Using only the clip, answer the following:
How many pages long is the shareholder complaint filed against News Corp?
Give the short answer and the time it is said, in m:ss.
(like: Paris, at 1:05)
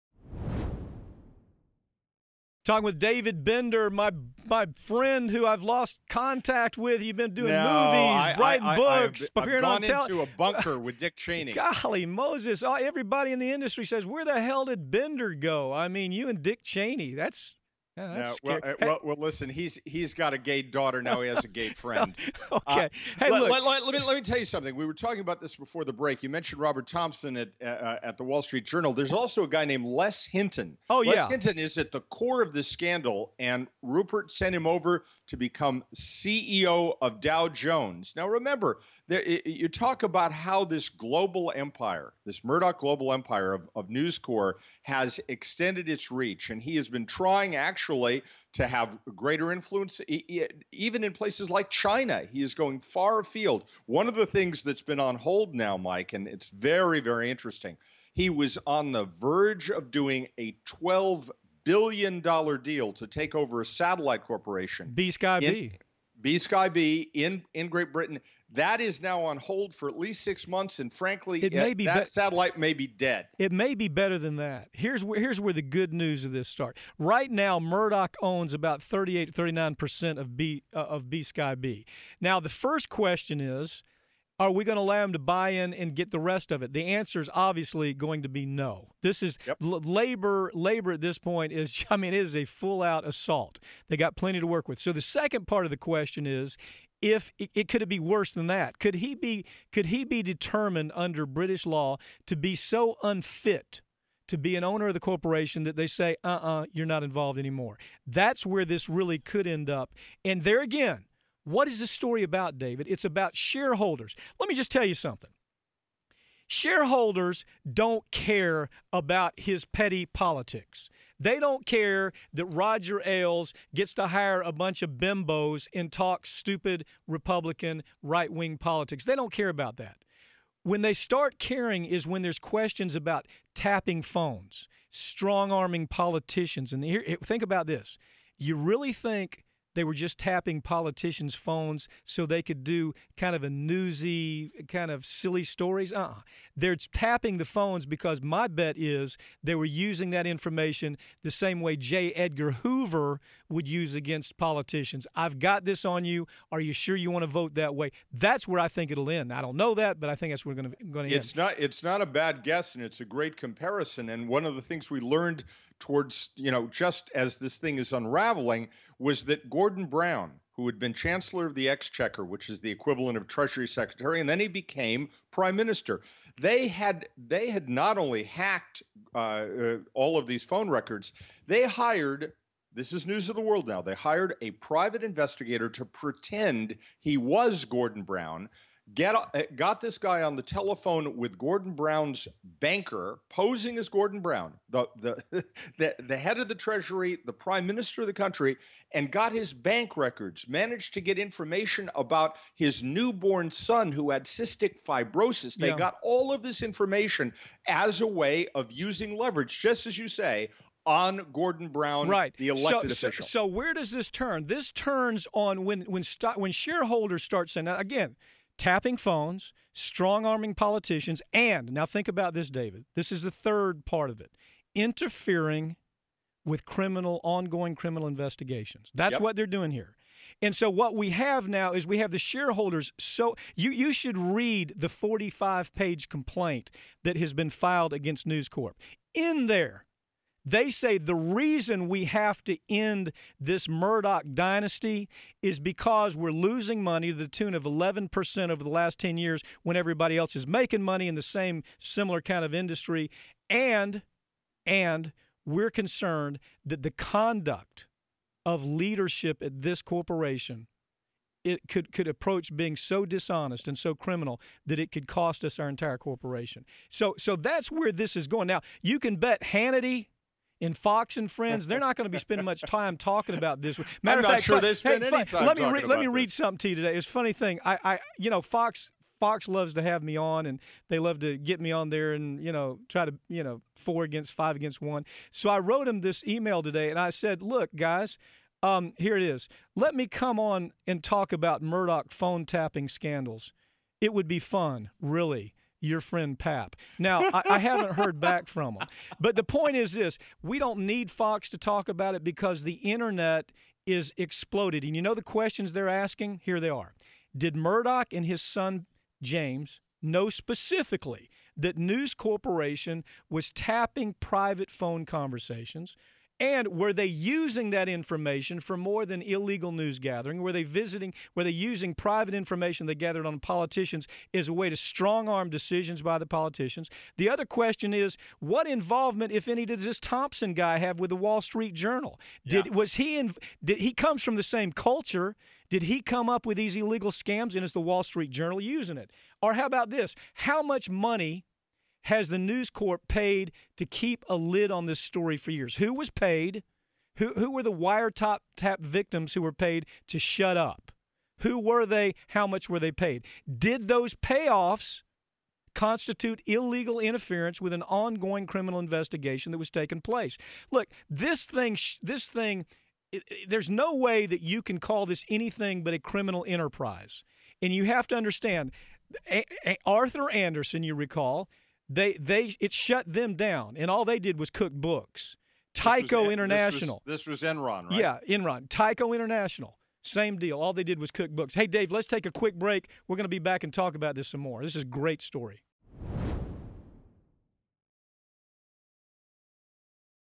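45, at 3:54.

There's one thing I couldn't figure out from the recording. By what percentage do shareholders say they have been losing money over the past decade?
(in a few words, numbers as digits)
11%.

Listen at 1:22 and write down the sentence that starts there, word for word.
Now, the first question is, are we going to allow him to buy in and get the rest of it?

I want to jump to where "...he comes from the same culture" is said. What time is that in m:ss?
5:33.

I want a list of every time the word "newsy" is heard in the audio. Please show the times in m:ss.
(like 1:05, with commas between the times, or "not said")
2:23.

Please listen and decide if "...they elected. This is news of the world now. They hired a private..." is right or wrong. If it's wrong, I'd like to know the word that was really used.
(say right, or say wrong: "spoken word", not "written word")
wrong: "hired", not "elected".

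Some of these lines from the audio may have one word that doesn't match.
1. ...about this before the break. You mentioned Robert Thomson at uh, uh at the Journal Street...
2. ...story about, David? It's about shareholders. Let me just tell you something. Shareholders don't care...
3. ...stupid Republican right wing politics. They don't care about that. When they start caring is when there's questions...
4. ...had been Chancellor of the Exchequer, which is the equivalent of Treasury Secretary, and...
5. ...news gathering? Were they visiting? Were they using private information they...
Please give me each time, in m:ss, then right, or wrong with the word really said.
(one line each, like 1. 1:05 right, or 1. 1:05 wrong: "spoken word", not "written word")
1. 0:25 wrong: "Wall", not "Journal"
2. 1:51 right
3. 2:06 right
4. 2:50 right
5. 5:19 right.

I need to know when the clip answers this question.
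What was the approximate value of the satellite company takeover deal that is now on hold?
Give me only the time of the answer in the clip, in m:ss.
1:00.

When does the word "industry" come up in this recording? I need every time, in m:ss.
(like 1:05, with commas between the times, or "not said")
0:13, 4:12.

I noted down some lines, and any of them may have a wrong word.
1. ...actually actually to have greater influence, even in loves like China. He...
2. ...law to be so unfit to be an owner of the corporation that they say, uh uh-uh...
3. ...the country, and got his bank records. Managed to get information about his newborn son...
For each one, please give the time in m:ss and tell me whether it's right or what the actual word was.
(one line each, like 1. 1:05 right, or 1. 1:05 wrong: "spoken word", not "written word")
1. 0:47 wrong: "places", not "loves"
2. 1:41 right
3. 3:18 right.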